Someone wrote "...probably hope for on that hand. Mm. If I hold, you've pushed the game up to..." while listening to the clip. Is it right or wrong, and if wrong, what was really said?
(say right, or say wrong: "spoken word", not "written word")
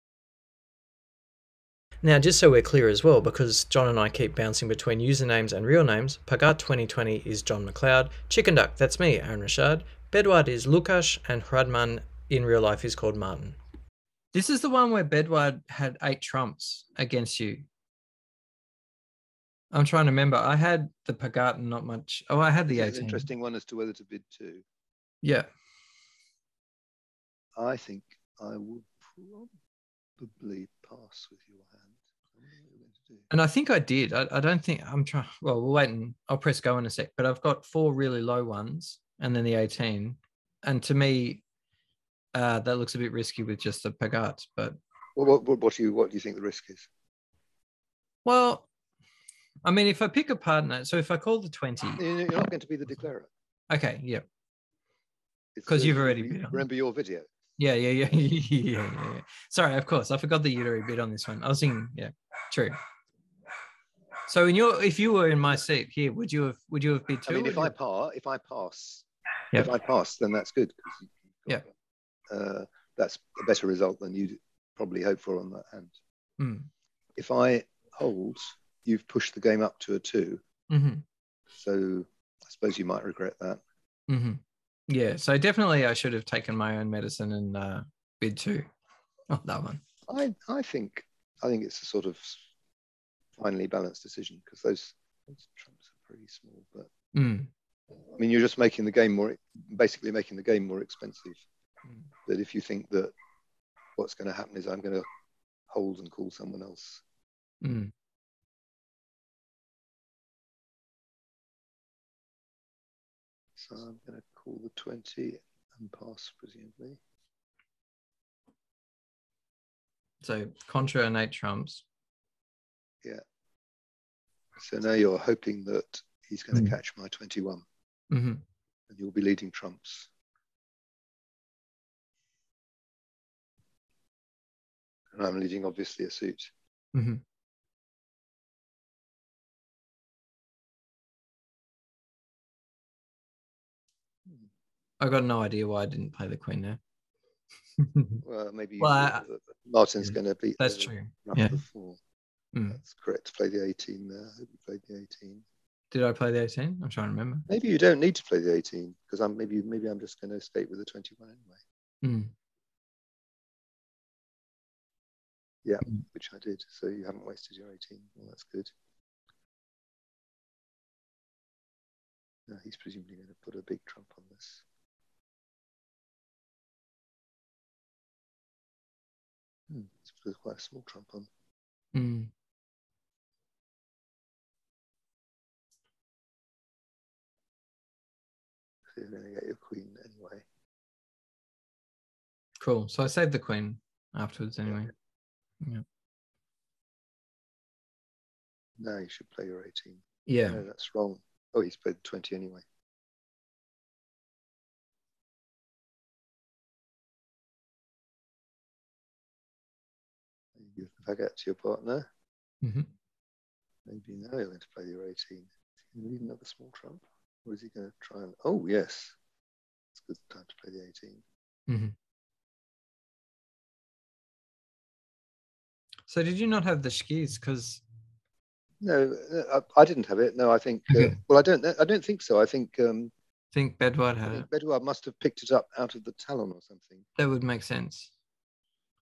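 right.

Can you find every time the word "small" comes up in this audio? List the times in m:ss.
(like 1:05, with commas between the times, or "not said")
1:36, 3:00, 3:36.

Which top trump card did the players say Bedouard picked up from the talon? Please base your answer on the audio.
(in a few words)
The skíz.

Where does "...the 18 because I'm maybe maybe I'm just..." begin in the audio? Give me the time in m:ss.
2:38.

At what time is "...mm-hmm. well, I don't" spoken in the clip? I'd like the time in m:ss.
3:50.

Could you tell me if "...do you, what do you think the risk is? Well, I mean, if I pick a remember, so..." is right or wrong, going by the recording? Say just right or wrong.
wrong.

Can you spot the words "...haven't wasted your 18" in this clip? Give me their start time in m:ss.
2:47.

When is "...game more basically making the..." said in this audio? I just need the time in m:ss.
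1:38.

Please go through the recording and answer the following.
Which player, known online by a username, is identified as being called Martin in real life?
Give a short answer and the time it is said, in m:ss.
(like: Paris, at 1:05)
Hradman, at 0:11.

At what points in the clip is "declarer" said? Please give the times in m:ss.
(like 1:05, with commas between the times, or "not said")
0:52.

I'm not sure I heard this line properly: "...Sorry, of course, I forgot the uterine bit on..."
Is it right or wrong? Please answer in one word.
right.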